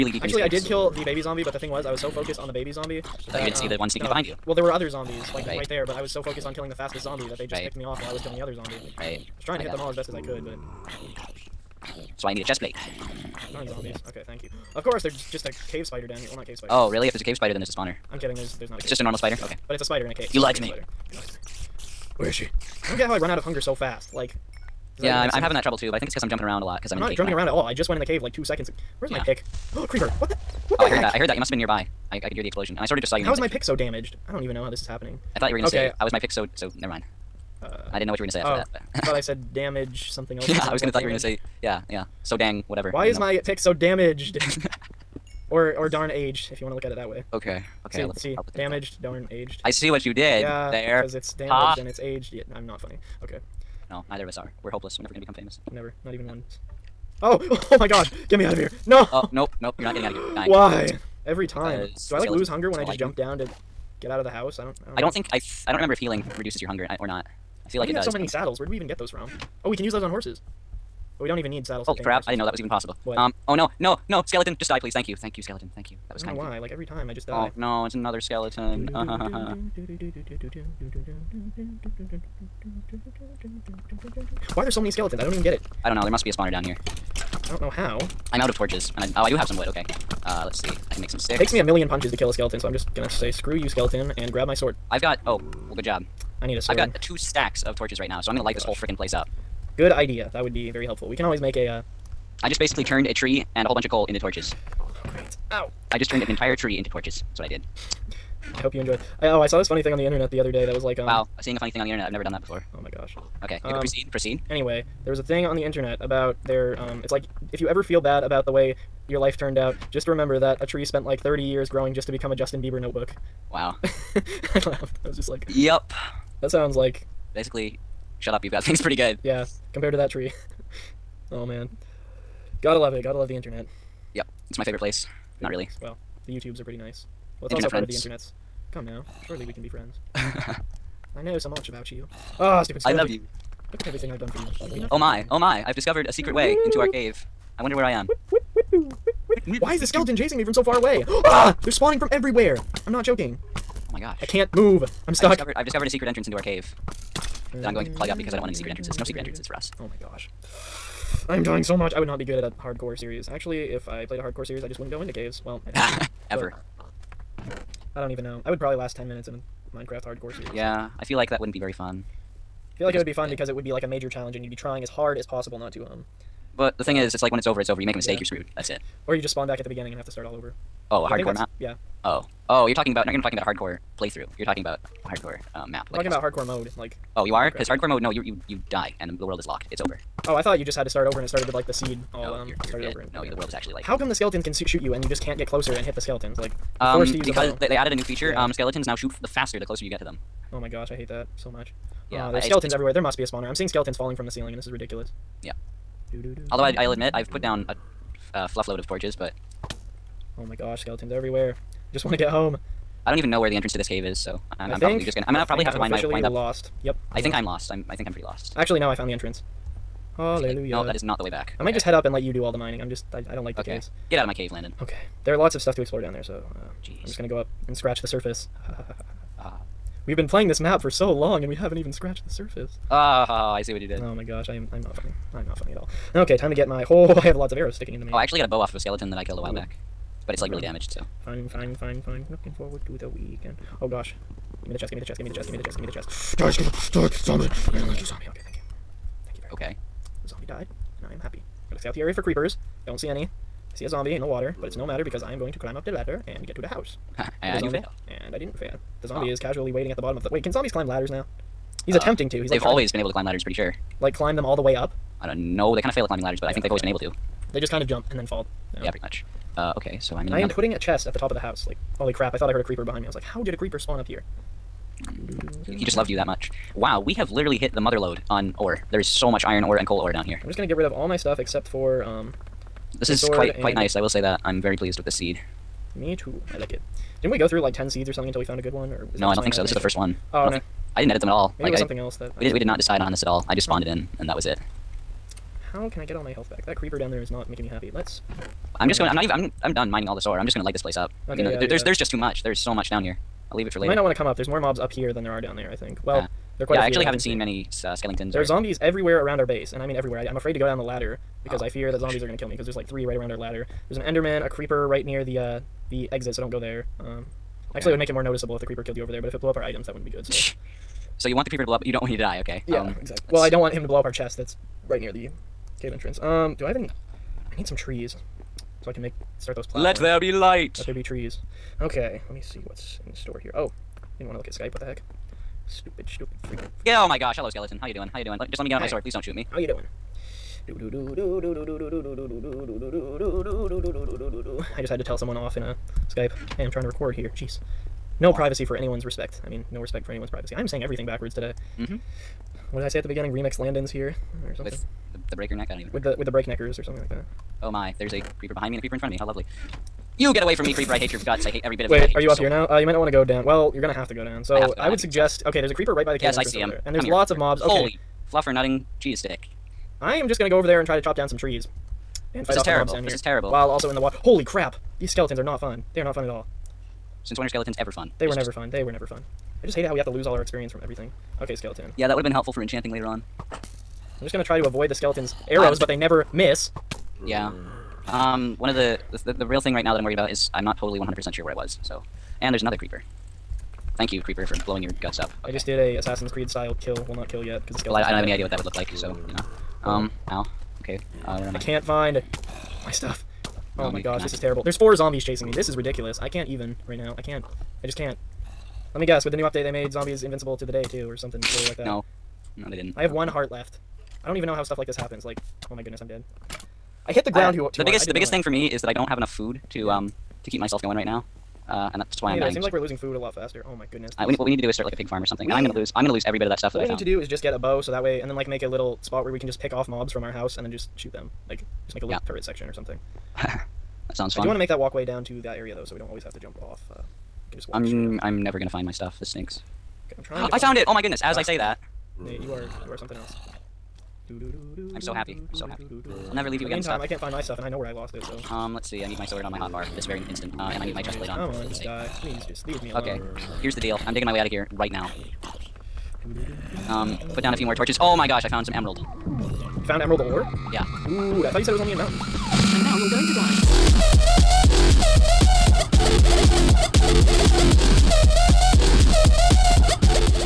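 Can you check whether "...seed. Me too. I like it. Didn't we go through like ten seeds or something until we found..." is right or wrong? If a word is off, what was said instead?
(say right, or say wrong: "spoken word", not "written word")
right.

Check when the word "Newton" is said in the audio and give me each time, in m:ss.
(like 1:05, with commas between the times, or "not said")
not said.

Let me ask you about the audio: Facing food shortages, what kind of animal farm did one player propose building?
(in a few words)
pig farm.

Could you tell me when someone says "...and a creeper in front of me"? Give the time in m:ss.
5:58.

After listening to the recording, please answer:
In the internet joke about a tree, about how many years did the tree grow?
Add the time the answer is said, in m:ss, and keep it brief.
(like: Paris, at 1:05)
30, at 2:01.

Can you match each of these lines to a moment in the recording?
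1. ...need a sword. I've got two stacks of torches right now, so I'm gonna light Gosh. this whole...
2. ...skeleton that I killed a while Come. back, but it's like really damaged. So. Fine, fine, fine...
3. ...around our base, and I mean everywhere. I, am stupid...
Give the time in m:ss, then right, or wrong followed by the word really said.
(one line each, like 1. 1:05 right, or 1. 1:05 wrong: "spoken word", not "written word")
1. 1:36 right
2. 3:58 wrong: "Ooh", not "Come"
3. 5:09 wrong: "afraid", not "stupid".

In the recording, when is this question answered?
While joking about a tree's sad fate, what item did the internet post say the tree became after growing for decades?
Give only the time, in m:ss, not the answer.
2:02.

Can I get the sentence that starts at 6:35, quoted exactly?
I just did a Assassin's Creed style kill.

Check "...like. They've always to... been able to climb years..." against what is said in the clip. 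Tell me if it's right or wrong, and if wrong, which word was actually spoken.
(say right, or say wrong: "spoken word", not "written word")
wrong: "ladders", not "years".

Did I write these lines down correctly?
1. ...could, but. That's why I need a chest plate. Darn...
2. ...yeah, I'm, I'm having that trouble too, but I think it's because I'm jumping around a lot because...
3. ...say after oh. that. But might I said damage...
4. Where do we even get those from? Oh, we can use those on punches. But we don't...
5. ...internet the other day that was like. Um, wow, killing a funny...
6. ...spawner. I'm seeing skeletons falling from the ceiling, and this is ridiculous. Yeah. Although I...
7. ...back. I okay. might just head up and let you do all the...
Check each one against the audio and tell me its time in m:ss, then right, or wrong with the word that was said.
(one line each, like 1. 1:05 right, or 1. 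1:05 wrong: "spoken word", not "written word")
1. 0:10 right
2. 0:25 right
3. 0:38 wrong: "thought", not "might"
4. 1:08 wrong: "horses", not "punches"
5. 1:50 wrong: "seeing", not "killing"
6. 3:23 right
7. 3:41 right.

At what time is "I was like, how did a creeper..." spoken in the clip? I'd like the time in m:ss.
4:33.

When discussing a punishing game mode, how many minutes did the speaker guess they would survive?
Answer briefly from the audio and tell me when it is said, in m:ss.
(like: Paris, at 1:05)
10, at 2:48.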